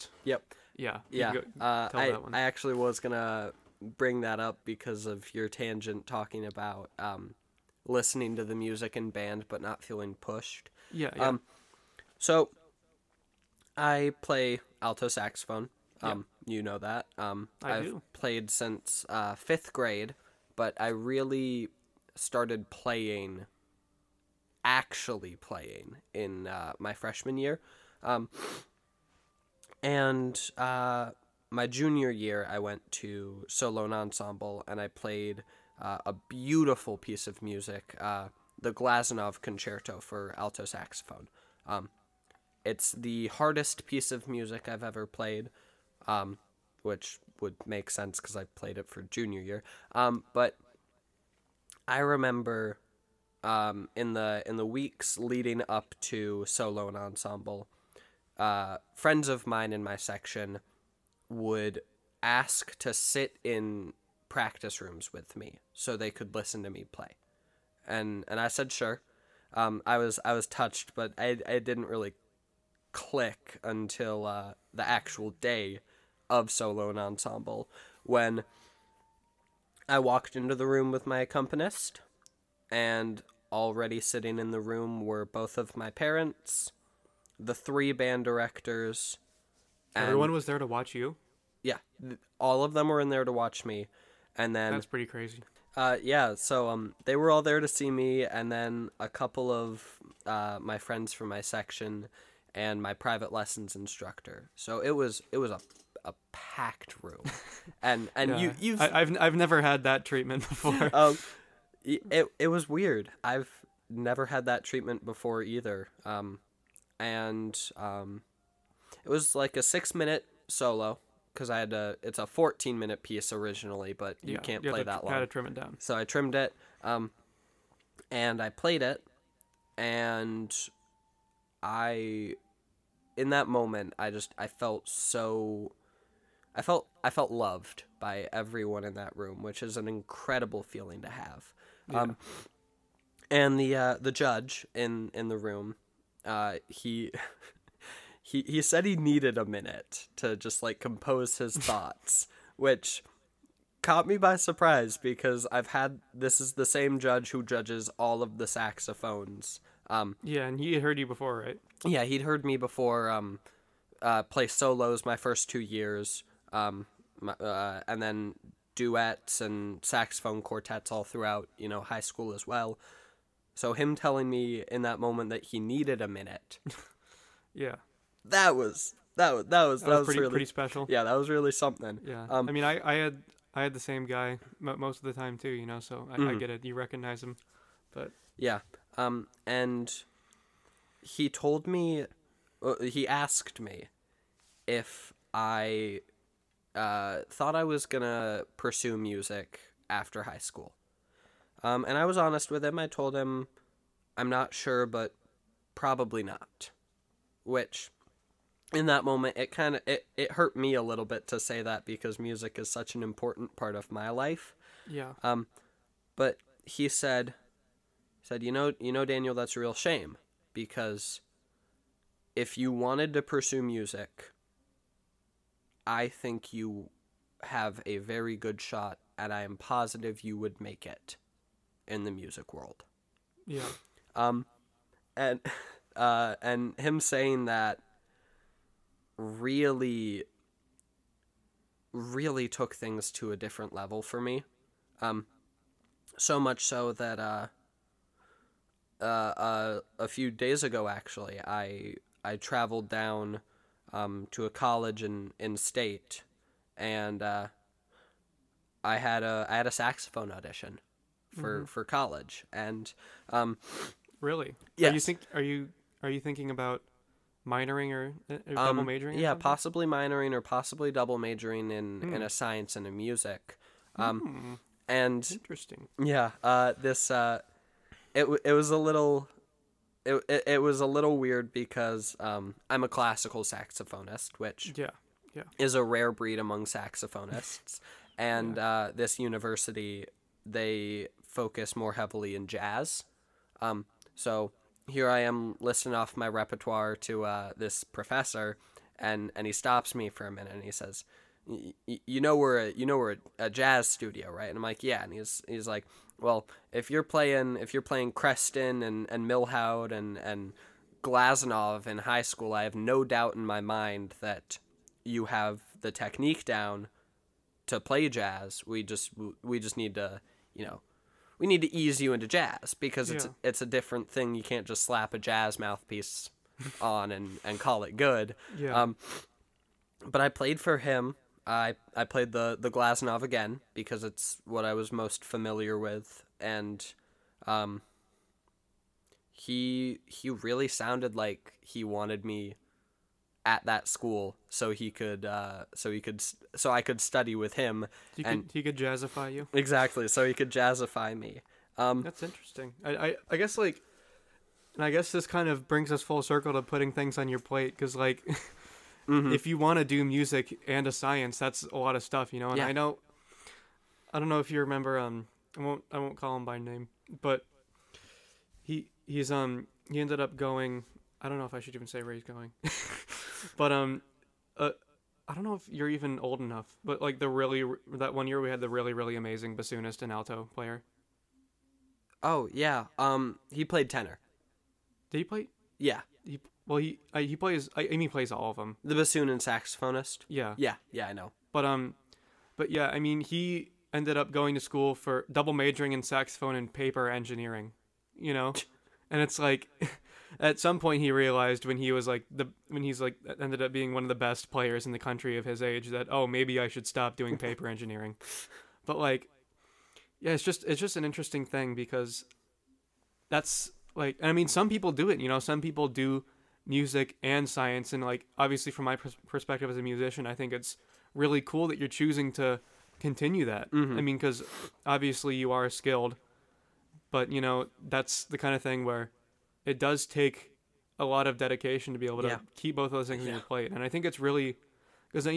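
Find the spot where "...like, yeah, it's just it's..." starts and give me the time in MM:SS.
06:48.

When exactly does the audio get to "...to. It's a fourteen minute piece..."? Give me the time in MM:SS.
02:01.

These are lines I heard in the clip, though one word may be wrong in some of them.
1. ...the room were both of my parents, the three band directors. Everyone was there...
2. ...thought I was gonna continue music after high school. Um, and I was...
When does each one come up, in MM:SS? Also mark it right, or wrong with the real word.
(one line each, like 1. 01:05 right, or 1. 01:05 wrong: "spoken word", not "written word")
1. 01:24 right
2. 03:17 wrong: "pursue", not "continue".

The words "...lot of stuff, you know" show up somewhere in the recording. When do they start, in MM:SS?
06:01.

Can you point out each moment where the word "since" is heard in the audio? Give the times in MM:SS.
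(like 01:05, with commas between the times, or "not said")
00:18.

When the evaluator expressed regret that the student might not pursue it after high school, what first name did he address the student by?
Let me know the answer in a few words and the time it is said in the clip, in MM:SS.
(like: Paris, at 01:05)
Daniel, at 03:39.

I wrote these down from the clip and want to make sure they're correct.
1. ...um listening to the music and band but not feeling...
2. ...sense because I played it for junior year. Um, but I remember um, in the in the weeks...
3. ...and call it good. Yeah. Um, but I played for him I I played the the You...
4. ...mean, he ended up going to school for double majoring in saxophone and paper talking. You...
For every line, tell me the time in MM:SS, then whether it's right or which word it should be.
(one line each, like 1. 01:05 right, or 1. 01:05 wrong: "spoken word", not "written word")
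1. 00:06 right
2. 00:47 right
3. 05:27 wrong: "Glazunov", not "You"
4. 06:32 wrong: "engineering", not "talking".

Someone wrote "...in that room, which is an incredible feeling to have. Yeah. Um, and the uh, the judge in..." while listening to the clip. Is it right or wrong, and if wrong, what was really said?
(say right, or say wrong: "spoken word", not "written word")
right.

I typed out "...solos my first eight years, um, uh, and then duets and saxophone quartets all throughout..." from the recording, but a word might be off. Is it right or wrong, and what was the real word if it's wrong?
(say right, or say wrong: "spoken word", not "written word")
wrong: "two", not "eight".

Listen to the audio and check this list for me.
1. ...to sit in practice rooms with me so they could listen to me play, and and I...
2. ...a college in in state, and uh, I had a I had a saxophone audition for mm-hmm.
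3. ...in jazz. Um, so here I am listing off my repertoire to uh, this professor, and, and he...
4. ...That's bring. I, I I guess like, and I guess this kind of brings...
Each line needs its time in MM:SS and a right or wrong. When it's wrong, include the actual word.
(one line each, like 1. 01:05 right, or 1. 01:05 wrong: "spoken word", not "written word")
1. 01:02 right
2. 04:14 right
3. 04:52 right
4. 05:52 wrong: "interesting", not "bring".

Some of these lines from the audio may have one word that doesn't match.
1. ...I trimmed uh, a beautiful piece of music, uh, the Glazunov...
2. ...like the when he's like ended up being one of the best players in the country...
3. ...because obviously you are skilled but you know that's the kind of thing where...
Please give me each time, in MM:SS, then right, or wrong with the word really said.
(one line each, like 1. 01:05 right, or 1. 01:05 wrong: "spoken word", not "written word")
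1. 00:34 wrong: "played", not "trimmed"
2. 06:42 right
3. 07:04 right.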